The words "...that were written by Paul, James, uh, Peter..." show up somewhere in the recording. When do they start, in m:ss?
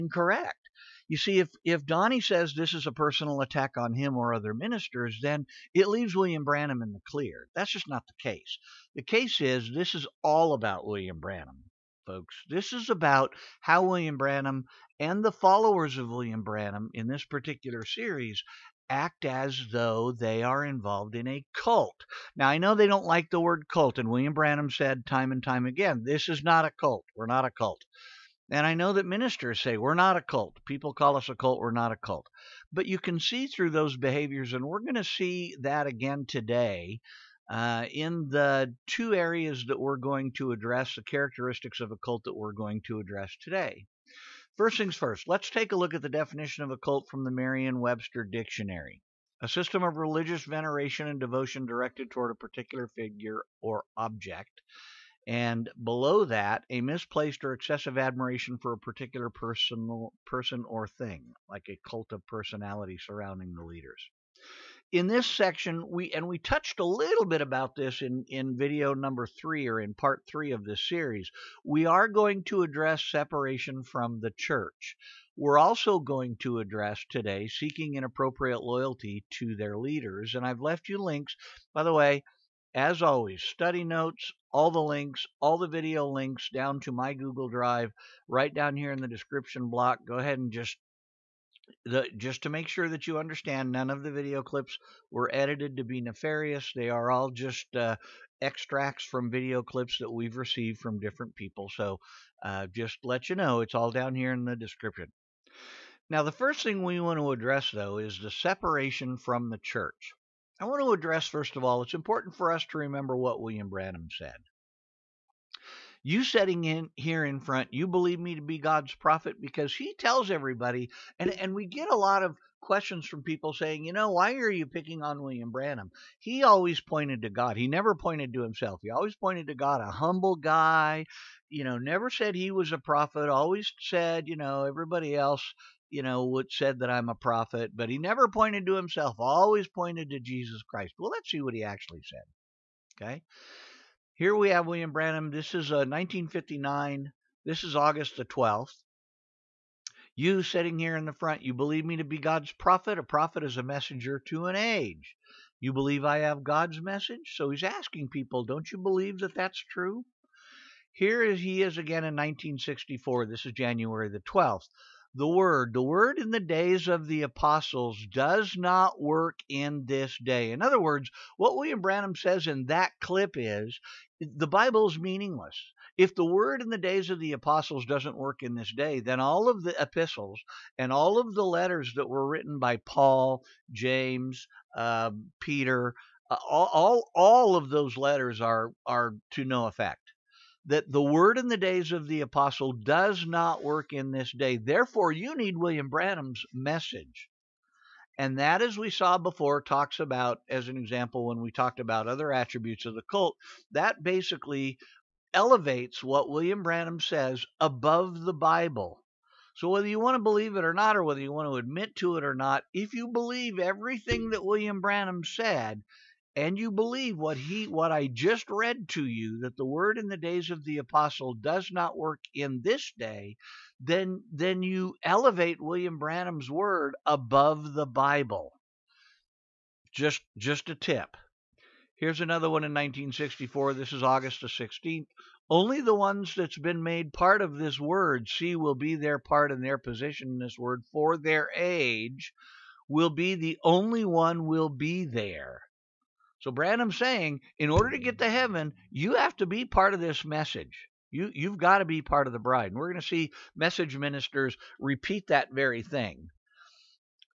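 3:01.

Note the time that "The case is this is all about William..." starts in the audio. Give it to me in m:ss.
0:08.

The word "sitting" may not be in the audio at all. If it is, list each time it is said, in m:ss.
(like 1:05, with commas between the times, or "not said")
1:56, 2:30.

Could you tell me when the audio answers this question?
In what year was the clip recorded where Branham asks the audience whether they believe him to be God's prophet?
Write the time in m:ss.
2:25.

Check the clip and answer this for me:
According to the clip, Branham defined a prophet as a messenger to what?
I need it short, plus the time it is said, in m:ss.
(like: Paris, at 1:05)
an age, at 2:33.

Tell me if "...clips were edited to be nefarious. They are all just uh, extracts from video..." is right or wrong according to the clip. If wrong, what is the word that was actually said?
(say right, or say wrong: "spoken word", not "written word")
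right.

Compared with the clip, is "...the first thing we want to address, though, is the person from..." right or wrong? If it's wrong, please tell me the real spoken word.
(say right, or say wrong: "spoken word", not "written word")
wrong: "separation", not "person".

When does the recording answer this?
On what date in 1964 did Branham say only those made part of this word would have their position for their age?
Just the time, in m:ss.
3:54.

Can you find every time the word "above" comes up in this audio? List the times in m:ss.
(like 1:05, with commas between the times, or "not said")
3:27, 3:47.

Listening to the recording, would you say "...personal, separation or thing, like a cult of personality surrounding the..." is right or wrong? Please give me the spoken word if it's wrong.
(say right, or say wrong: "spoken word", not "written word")
wrong: "person", not "separation".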